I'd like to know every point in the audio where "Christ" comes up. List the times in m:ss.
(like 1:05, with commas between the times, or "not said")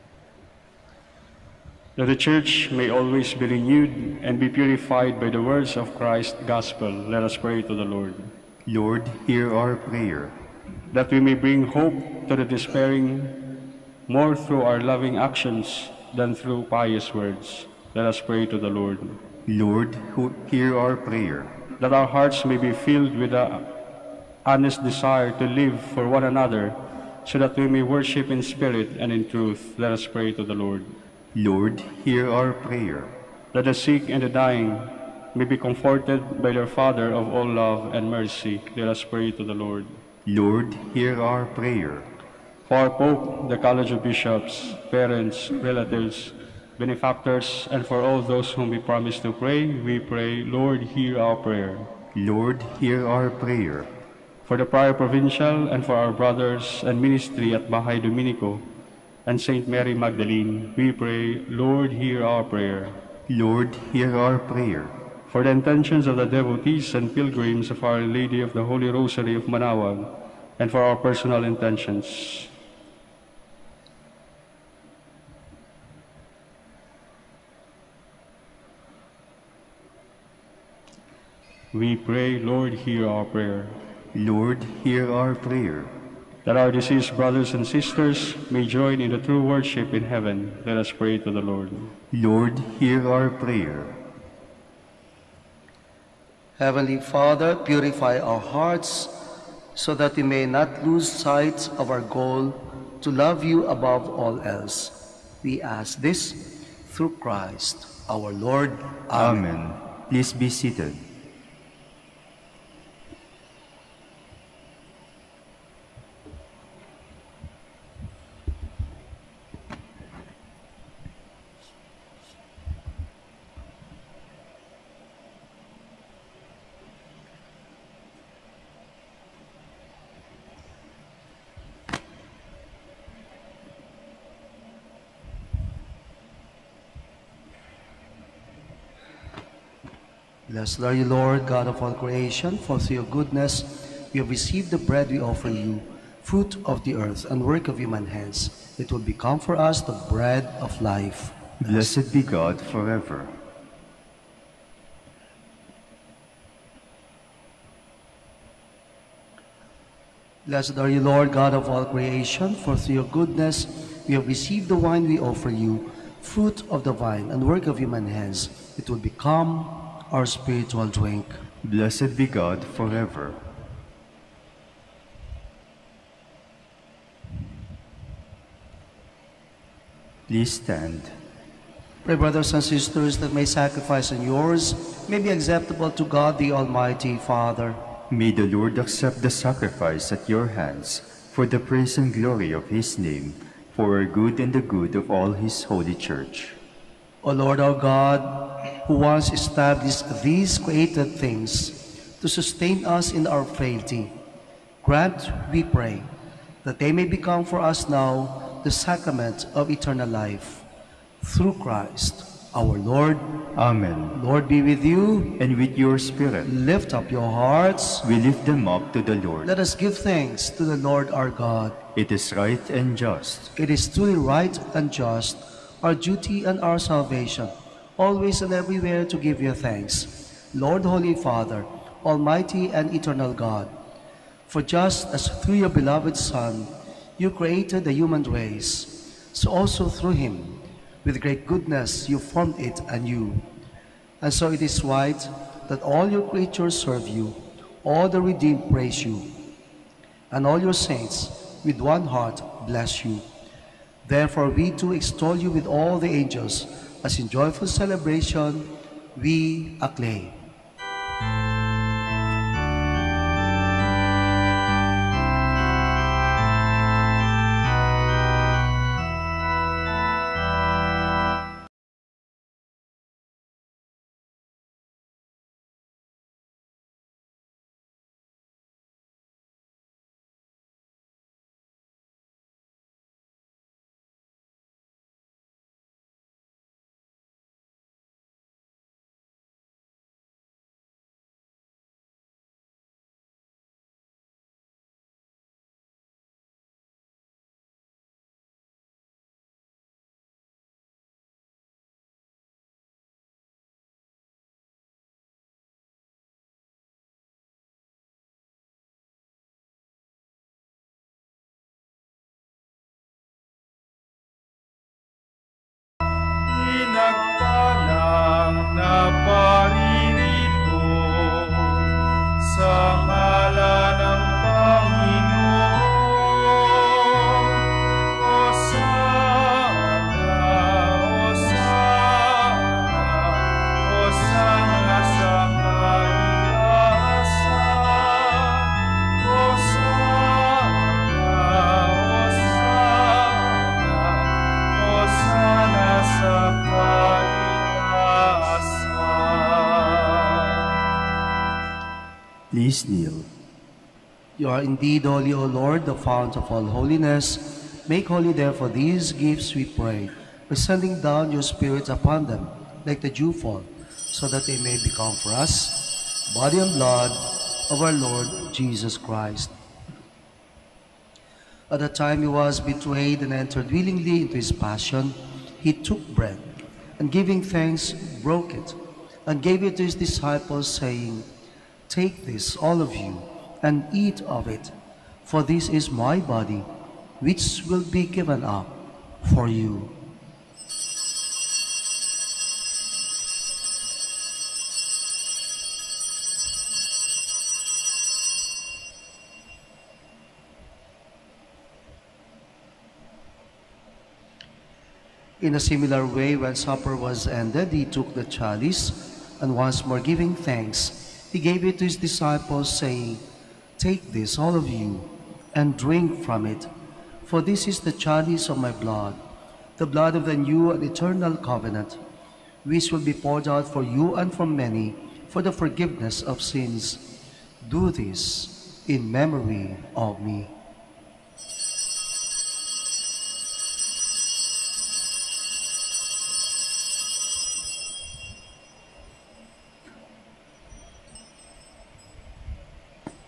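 0:05, 1:47, 3:31, 6:08.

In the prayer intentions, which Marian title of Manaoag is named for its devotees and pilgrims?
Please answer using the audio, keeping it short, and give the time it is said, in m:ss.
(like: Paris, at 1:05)
Our Lady of the Holy Rosary, at 1:07.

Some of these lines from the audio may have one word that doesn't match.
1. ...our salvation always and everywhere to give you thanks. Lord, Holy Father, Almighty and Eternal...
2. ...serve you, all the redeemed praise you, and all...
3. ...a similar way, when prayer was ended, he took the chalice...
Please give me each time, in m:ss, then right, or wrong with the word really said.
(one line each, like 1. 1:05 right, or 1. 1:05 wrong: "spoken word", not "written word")
1. 3:46 right
2. 4:06 right
3. 6:45 wrong: "supper", not "prayer".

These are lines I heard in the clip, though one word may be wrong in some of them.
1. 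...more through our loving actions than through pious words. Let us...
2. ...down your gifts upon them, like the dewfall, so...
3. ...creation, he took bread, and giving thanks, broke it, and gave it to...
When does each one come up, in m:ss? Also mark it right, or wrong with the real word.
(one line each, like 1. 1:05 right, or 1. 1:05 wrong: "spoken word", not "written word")
1. 0:14 right
2. 6:00 wrong: "spirits", not "gifts"
3. 6:14 wrong: "passion", not "creation".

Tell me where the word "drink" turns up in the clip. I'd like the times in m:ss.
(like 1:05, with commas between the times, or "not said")
2:50, 6:55.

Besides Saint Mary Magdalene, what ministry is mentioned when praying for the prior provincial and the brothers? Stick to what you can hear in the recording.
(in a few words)
Bahay Dominico.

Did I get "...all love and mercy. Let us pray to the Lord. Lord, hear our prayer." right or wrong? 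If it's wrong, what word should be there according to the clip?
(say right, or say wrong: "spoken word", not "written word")
right.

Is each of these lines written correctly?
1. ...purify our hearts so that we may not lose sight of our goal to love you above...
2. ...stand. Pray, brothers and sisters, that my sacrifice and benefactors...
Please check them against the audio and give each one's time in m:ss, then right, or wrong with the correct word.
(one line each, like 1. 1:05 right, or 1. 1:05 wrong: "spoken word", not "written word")
1. 1:37 right
2. 3:00 wrong: "yours", not "benefactors".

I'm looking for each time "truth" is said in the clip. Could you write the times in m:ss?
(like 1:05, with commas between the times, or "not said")
0:29.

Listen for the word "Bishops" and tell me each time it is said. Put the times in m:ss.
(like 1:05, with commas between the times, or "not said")
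0:44.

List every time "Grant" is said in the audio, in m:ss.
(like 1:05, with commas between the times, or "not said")
3:24.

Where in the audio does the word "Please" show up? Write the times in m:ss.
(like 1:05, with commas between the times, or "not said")
1:50, 3:00.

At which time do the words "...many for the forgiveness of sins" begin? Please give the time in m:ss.
7:04.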